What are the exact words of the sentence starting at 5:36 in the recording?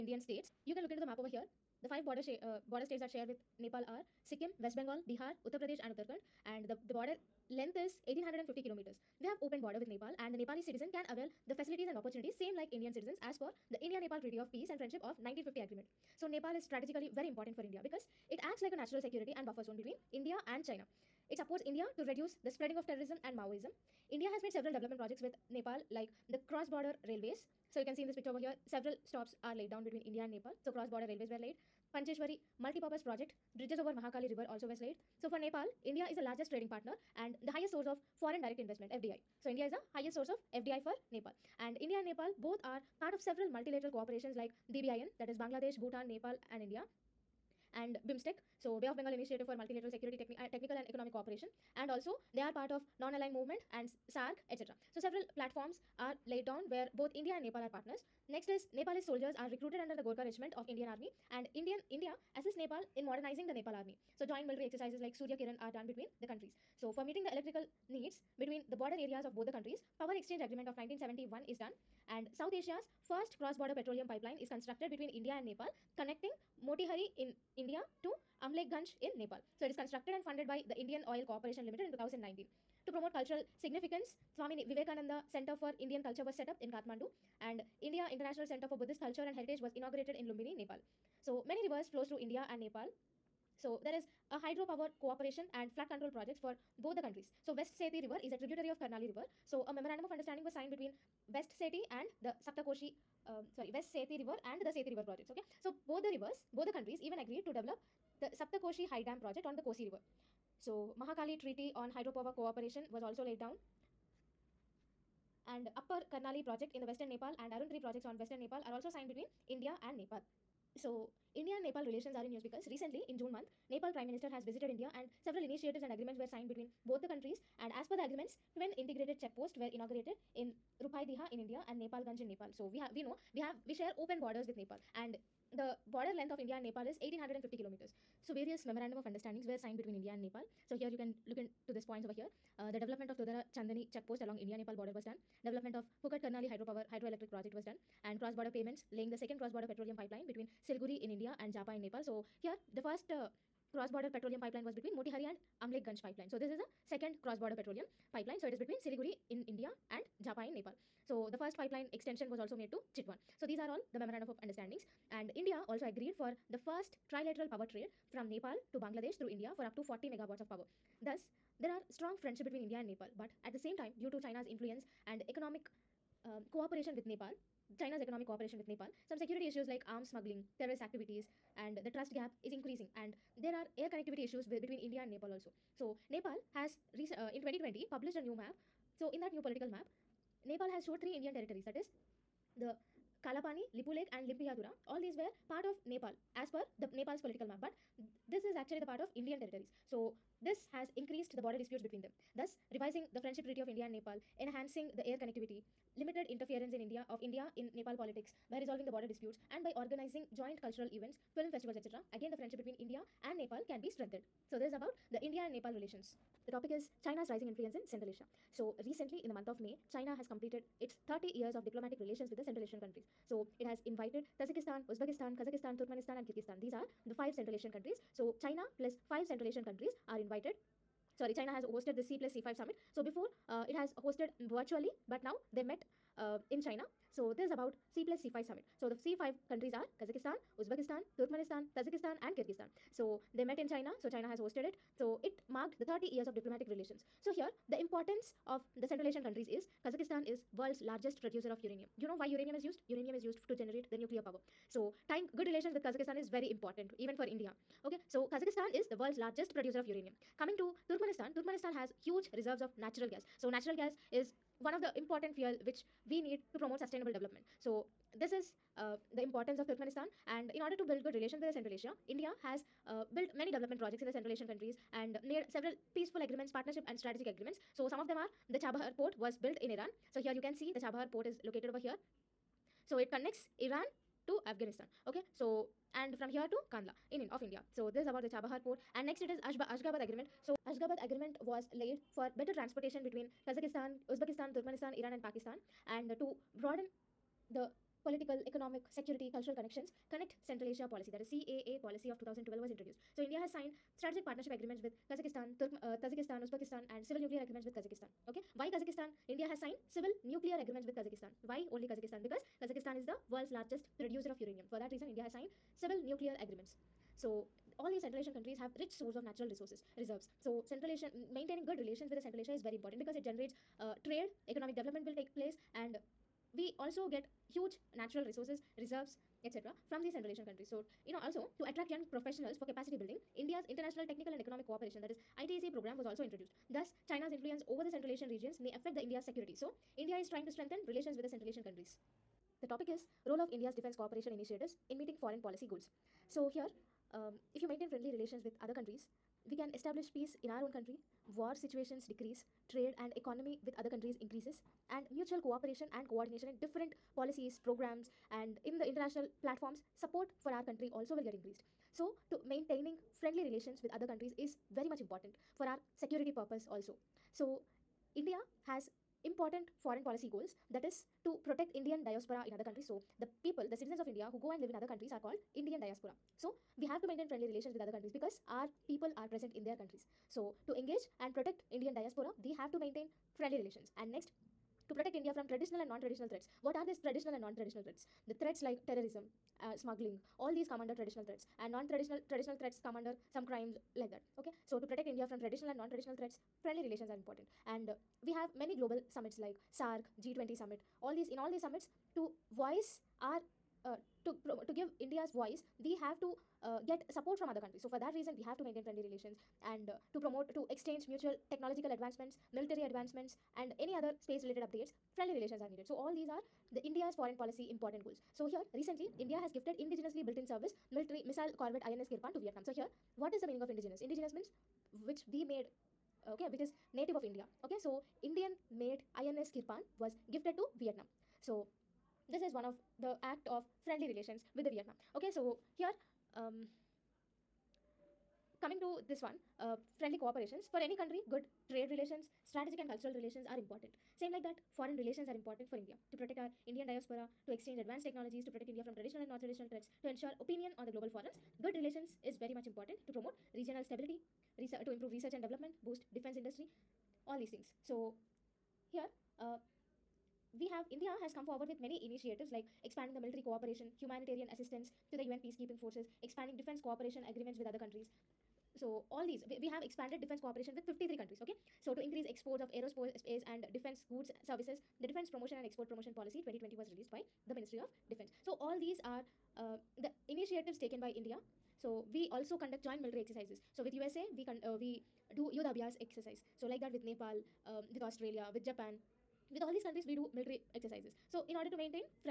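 Thus, China's influence over the Central Asian regions may affect the India's security.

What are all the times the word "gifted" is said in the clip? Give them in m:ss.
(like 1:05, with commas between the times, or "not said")
6:59, 7:10.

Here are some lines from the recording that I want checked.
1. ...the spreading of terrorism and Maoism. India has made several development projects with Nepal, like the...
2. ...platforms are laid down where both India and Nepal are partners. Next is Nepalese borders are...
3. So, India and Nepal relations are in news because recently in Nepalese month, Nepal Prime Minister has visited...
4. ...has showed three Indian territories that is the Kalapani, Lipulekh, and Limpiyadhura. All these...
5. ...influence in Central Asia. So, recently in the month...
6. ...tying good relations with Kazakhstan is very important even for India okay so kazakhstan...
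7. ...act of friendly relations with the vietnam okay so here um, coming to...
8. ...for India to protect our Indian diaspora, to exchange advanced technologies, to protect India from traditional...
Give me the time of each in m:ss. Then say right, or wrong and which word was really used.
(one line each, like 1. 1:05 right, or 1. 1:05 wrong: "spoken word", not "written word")
1. 0:22 right
2. 0:55 wrong: "soldiers", not "borders"
3. 2:00 wrong: "June", not "Nepalese"
4. 3:10 right
5. 3:37 right
6. 4:15 right
7. 7:13 right
8. 7:25 right.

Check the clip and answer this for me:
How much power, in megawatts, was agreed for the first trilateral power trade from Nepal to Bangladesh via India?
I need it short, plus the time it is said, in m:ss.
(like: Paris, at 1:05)
40 megawatts, at 2:49.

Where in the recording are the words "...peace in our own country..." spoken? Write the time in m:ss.
5:50.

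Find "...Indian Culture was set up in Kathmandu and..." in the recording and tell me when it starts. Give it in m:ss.
1:25.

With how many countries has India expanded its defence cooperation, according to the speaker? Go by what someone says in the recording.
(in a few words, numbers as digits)
53.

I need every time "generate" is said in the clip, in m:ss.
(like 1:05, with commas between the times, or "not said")
4:13, 5:23.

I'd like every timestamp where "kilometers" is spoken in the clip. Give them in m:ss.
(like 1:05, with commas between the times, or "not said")
0:08, 2:17.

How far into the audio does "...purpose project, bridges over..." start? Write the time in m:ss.
0:32.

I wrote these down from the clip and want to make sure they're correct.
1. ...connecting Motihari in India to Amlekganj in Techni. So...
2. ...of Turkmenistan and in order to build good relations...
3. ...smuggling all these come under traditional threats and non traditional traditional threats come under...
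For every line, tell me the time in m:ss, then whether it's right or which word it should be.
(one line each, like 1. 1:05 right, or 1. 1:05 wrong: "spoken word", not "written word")
1. 1:15 wrong: "Nepal", not "Techni"
2. 4:29 right
3. 6:29 right.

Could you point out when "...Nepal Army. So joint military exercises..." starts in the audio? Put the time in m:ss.
1:03.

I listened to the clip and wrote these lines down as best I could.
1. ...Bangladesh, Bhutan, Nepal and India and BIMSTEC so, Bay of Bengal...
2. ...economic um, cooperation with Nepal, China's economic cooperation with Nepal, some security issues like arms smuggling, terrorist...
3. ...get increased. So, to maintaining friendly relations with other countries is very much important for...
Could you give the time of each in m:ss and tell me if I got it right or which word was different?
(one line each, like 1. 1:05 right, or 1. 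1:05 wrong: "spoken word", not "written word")
1. 0:45 right
2. 2:55 right
3. 6:01 right.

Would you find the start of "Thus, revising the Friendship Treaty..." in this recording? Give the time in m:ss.
3:22.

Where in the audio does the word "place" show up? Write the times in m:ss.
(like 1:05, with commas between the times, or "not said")
5:25.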